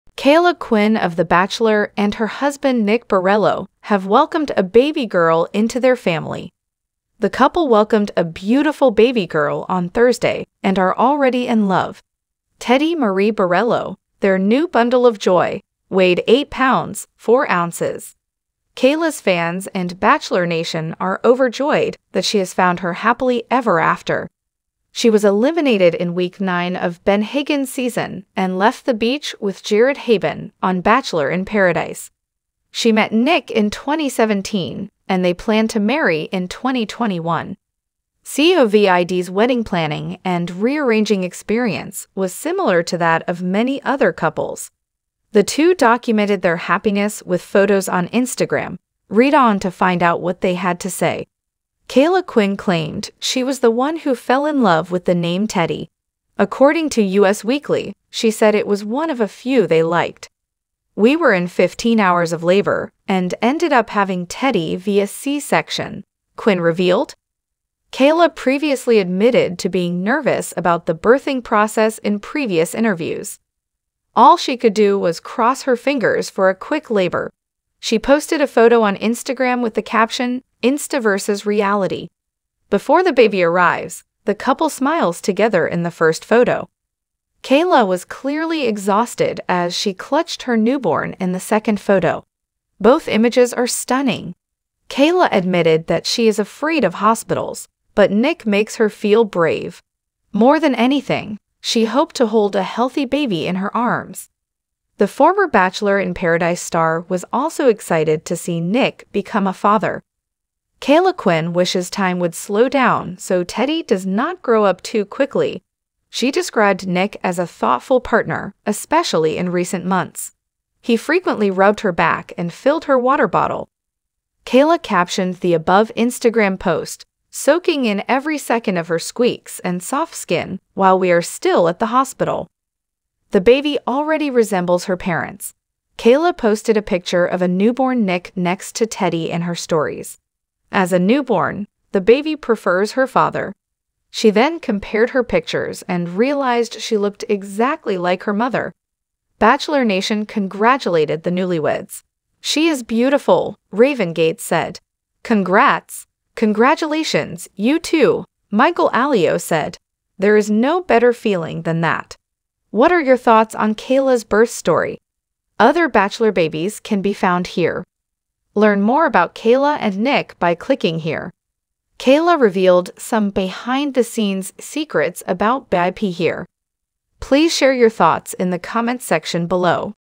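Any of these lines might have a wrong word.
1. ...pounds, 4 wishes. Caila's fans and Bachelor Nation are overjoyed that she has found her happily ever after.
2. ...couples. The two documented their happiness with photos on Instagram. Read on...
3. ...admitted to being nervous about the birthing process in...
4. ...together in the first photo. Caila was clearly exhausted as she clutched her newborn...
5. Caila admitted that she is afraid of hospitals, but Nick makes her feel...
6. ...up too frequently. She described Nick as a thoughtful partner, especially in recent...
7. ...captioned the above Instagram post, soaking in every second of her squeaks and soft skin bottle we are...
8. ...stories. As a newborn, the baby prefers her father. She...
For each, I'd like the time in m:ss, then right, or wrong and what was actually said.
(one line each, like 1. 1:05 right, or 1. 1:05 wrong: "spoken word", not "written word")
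1. 0:16 wrong: "ounces", not "wishes"
2. 0:44 right
3. 1:08 right
4. 1:25 right
5. 1:34 right
6. 1:54 wrong: "quickly", not "frequently"
7. 2:04 wrong: "while", not "bottle"
8. 2:19 right.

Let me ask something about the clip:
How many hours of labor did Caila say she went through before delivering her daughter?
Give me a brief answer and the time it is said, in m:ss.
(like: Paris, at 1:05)
15 hours, at 1:01.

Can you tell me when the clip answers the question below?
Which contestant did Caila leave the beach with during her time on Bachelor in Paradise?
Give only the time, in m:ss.
0:29.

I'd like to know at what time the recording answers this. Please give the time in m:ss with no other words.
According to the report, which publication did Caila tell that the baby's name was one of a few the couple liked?
0:57.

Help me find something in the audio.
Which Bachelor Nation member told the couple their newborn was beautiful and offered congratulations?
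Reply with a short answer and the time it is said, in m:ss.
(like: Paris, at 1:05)
Raven Gates, at 2:33.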